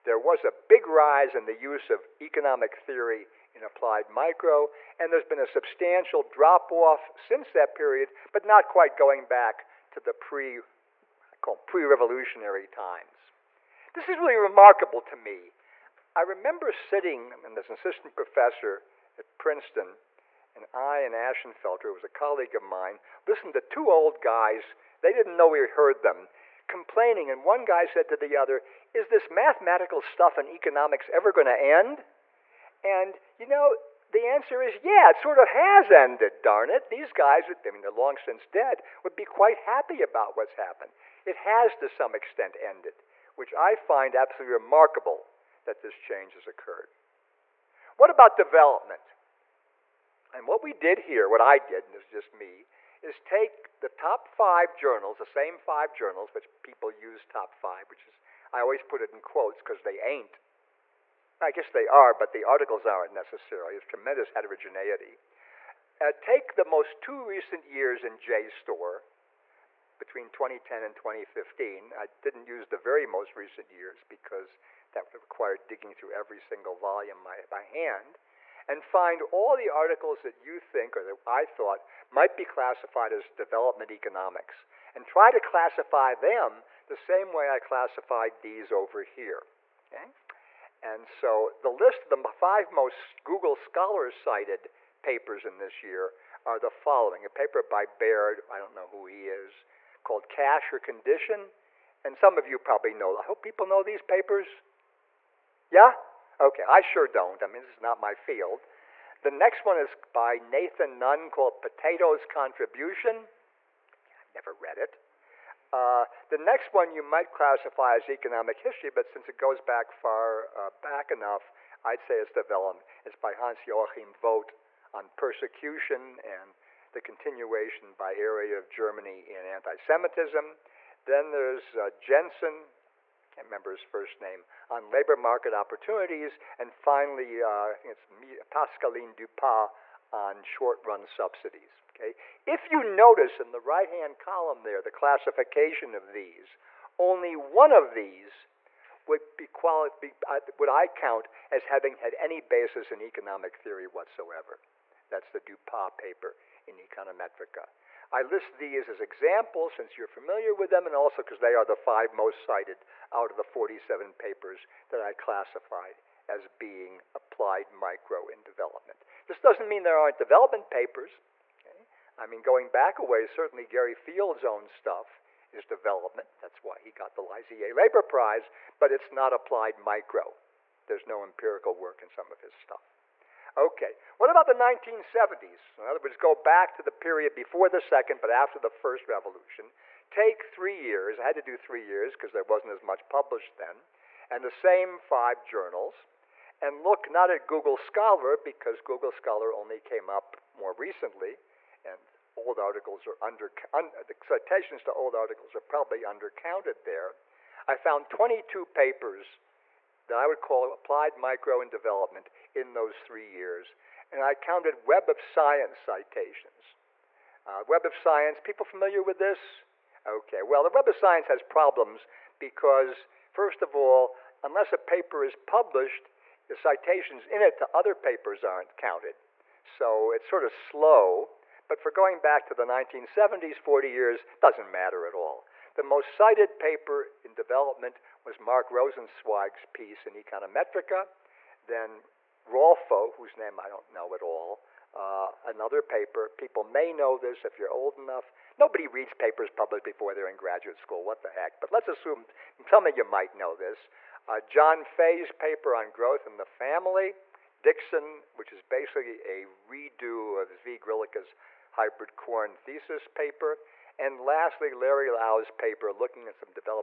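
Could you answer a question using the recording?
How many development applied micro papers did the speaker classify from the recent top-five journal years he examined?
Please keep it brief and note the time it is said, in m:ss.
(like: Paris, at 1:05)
47, at 2:43.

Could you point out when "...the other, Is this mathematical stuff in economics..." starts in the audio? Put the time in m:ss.
0:28.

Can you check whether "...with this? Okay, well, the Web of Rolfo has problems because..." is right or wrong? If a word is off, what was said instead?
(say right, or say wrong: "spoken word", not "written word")
wrong: "Science", not "Rolfo".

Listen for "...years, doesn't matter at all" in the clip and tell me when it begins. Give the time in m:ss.
3:53.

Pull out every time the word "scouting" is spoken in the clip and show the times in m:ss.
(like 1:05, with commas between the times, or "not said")
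not said.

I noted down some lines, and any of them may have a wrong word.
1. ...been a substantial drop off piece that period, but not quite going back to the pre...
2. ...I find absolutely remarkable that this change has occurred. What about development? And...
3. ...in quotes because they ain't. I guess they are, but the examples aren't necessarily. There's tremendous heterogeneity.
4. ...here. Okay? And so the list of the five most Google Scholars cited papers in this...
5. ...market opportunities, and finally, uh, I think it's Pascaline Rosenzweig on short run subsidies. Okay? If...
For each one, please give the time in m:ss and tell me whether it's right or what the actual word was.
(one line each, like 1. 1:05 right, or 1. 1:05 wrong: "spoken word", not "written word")
1. 0:05 wrong: "since", not "piece"
2. 0:43 right
3. 0:59 wrong: "articles", not "examples"
4. 1:29 right
5. 2:15 wrong: "Dupas", not "Rosenzweig".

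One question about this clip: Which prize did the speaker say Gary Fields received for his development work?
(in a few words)
IZA Labor Prize.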